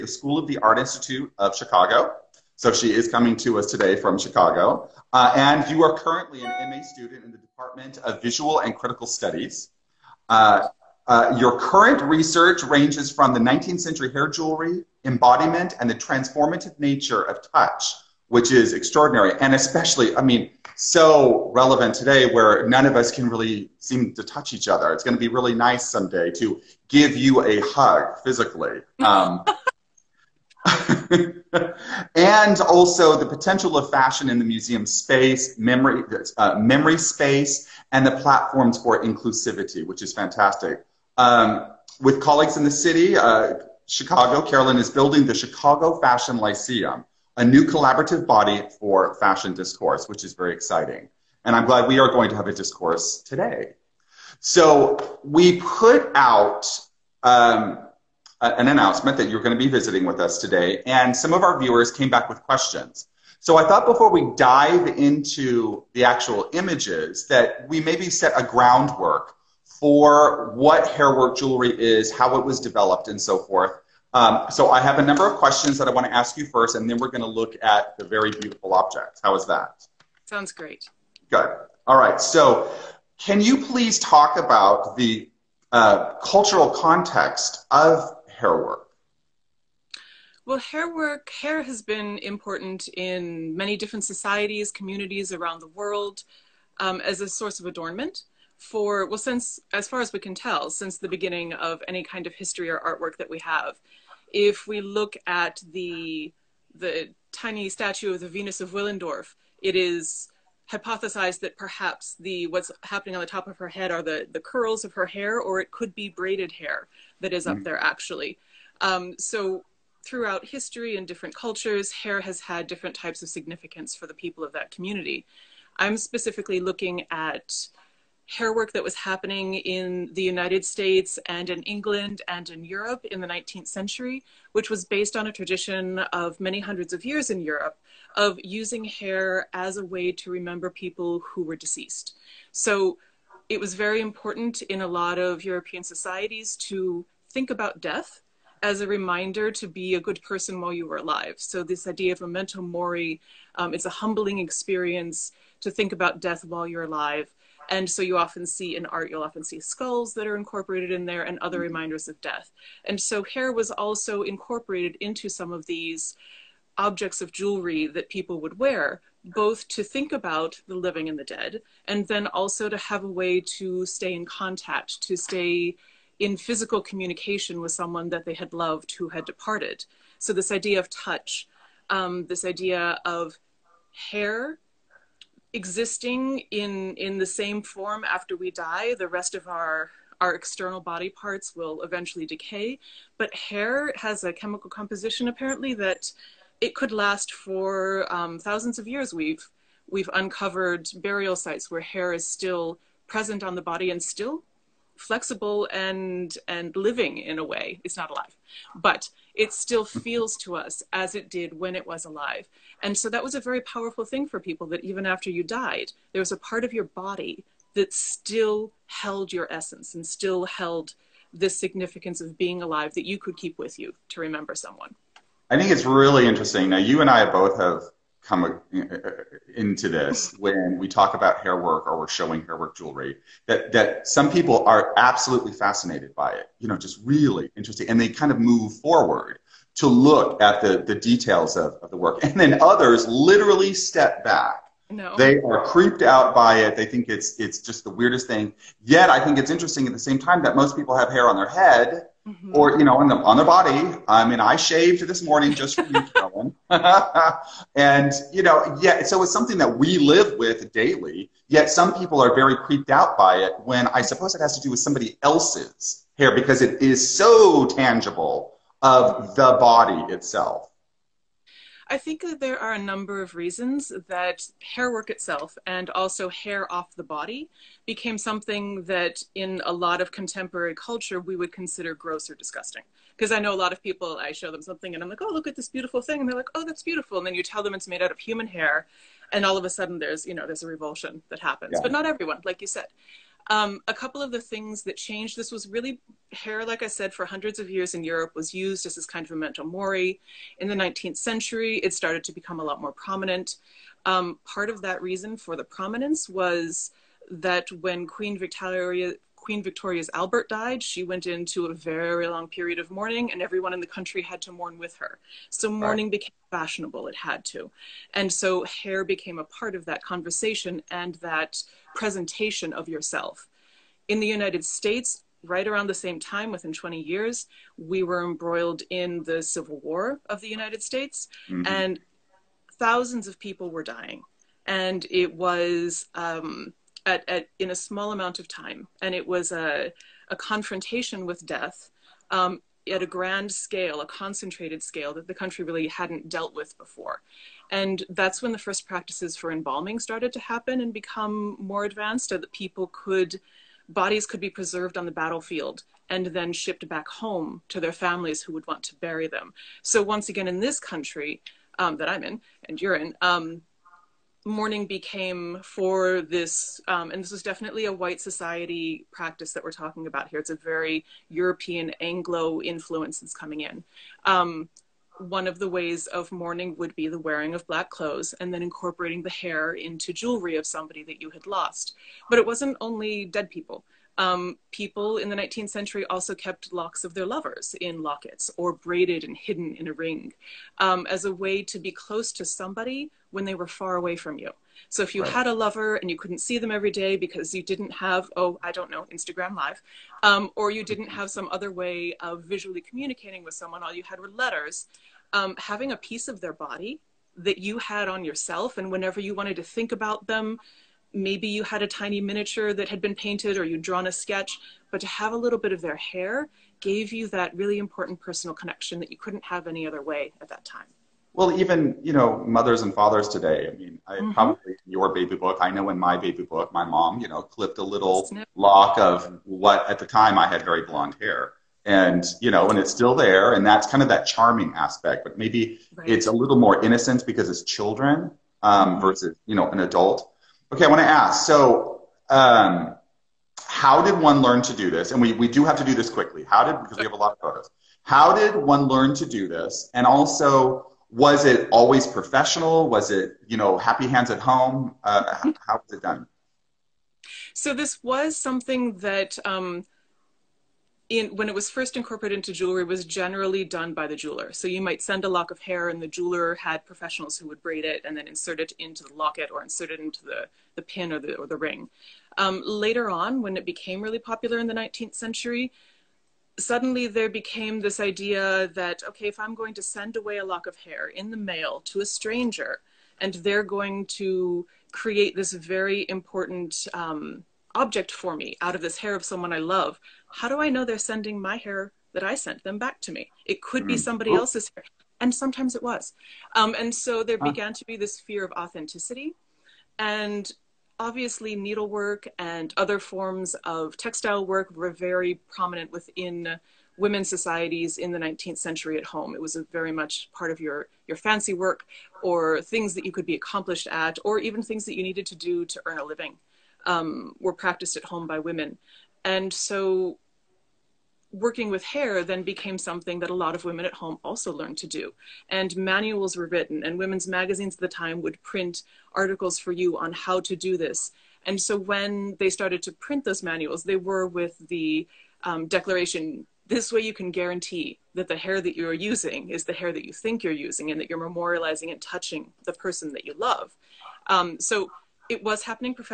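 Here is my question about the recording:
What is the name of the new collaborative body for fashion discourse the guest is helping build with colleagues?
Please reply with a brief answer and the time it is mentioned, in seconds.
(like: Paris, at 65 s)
Chicago Fashion Lyceum, at 45 s.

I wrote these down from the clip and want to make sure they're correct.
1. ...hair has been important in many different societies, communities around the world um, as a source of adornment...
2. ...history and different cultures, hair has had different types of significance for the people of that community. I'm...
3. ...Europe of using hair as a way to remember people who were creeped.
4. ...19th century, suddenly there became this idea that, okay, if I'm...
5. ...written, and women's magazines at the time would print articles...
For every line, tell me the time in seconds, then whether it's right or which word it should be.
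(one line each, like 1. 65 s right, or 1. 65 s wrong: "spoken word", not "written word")
1. 91 s right
2. 120 s right
3. 137 s wrong: "deceased", not "creeped"
4. 474 s right
5. 526 s right.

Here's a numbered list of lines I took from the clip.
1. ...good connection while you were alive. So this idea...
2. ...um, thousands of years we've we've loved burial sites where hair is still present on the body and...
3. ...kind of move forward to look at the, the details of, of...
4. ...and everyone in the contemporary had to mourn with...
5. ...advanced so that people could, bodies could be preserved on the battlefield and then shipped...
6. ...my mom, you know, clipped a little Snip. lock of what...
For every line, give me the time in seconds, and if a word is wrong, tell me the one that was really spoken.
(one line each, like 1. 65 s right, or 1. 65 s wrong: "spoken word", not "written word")
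1. 150 s wrong: "person", not "connection"
2. 198 s wrong: "uncovered", not "loved"
3. 238 s right
4. 313 s wrong: "country", not "contemporary"
5. 351 s right
6. 426 s right.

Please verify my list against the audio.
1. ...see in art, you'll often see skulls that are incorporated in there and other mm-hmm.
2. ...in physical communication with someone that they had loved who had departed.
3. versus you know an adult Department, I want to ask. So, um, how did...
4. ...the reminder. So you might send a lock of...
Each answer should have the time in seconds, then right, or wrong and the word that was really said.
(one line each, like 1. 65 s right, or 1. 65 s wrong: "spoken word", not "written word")
1. 158 s right
2. 176 s right
3. 438 s wrong: "Okay", not "Department"
4. 464 s wrong: "jeweler", not "reminder".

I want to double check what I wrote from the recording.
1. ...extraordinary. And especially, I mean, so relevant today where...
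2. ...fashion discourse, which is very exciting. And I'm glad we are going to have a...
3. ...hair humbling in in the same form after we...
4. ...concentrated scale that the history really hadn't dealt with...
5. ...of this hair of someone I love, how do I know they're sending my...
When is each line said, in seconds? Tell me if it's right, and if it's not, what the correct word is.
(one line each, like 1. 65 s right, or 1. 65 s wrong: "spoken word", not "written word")
1. 18 s right
2. 49 s right
3. 184 s wrong: "existing", not "humbling"
4. 344 s wrong: "country", not "history"
5. 488 s right.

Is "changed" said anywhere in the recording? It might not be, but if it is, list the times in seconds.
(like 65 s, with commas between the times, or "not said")
294 s.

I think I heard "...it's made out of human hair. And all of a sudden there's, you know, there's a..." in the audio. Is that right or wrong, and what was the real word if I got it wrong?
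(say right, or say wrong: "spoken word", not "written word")
right.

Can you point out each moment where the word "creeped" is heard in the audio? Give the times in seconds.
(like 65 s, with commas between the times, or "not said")
245 s, 262 s.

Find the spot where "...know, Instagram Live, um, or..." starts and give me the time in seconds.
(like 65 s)
398 s.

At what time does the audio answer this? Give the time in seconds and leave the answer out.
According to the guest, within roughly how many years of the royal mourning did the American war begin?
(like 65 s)
326 s.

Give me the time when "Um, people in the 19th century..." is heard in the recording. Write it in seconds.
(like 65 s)
384 s.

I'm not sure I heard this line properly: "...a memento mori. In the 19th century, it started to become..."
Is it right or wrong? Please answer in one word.
right.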